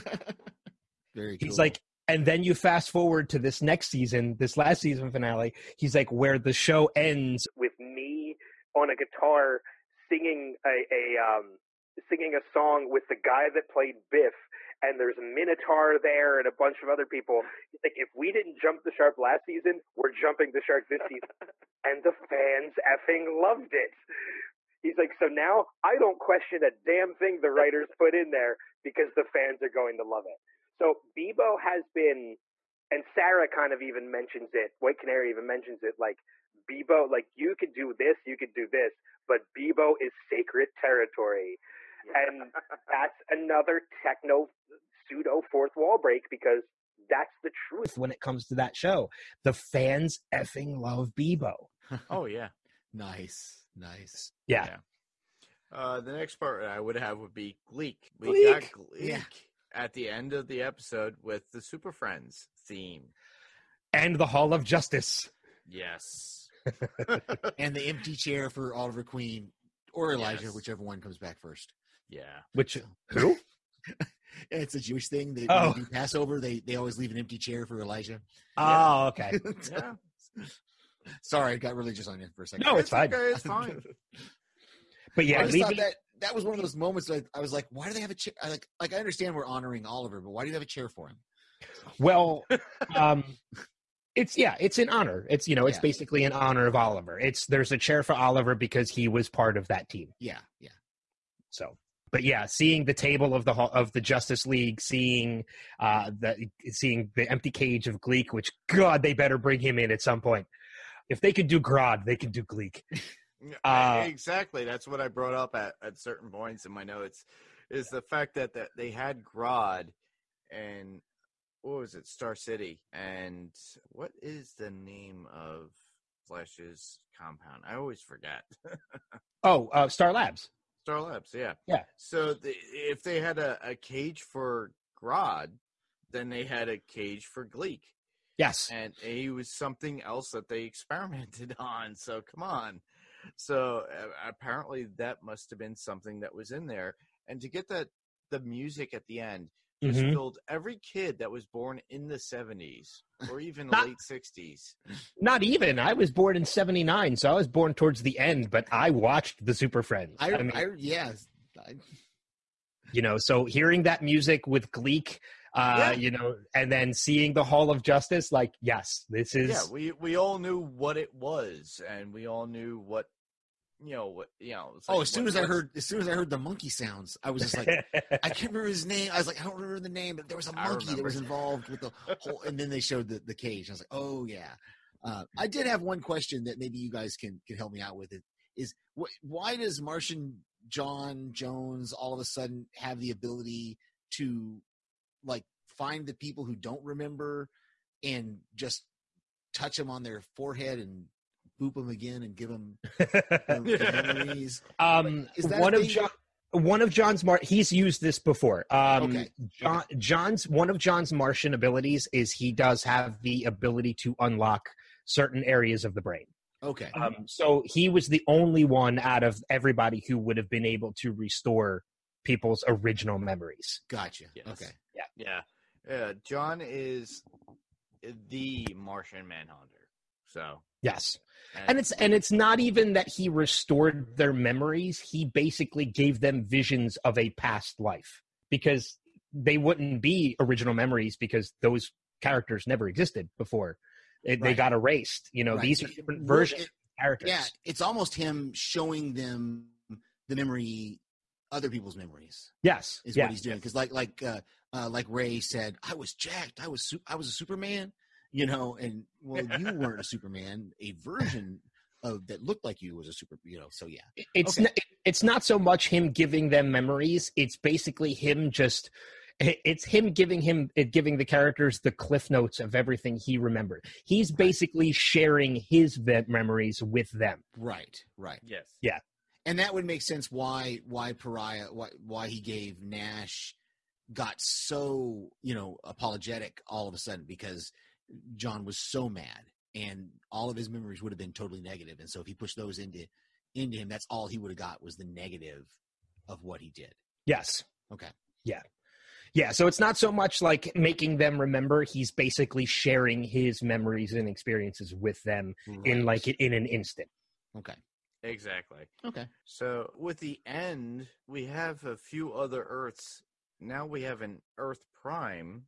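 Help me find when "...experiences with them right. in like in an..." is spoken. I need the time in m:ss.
5:04.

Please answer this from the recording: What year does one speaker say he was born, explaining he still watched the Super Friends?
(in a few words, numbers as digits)
1979.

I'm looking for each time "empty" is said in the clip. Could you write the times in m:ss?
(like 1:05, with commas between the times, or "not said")
1:07, 1:17, 1:47.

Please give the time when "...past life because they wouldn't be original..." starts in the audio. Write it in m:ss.
3:57.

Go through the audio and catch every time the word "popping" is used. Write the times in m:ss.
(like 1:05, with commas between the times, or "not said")
not said.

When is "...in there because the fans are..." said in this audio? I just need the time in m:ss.
0:28.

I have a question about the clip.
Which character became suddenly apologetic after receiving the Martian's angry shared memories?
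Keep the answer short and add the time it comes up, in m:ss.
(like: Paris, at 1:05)
Pariah, at 4:41.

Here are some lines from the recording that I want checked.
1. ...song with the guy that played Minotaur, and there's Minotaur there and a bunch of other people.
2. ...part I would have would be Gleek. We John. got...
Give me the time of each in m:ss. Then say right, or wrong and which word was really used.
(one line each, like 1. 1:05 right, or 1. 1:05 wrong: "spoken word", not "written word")
1. 0:12 wrong: "Biff", not "Minotaur"
2. 0:56 wrong: "Gleek", not "John".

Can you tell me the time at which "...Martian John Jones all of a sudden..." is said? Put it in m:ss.
3:09.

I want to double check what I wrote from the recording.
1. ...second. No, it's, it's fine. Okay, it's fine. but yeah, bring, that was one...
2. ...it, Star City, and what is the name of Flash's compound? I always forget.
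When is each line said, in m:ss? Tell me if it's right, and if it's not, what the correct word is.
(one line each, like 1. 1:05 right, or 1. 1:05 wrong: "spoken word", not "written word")
1. 1:22 wrong: "leaving", not "bring"
2. 2:01 right.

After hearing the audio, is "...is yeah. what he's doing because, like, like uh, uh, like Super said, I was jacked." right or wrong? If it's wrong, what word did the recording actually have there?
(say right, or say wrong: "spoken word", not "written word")
wrong: "Ray", not "Super".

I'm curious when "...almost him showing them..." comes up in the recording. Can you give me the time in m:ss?
4:07.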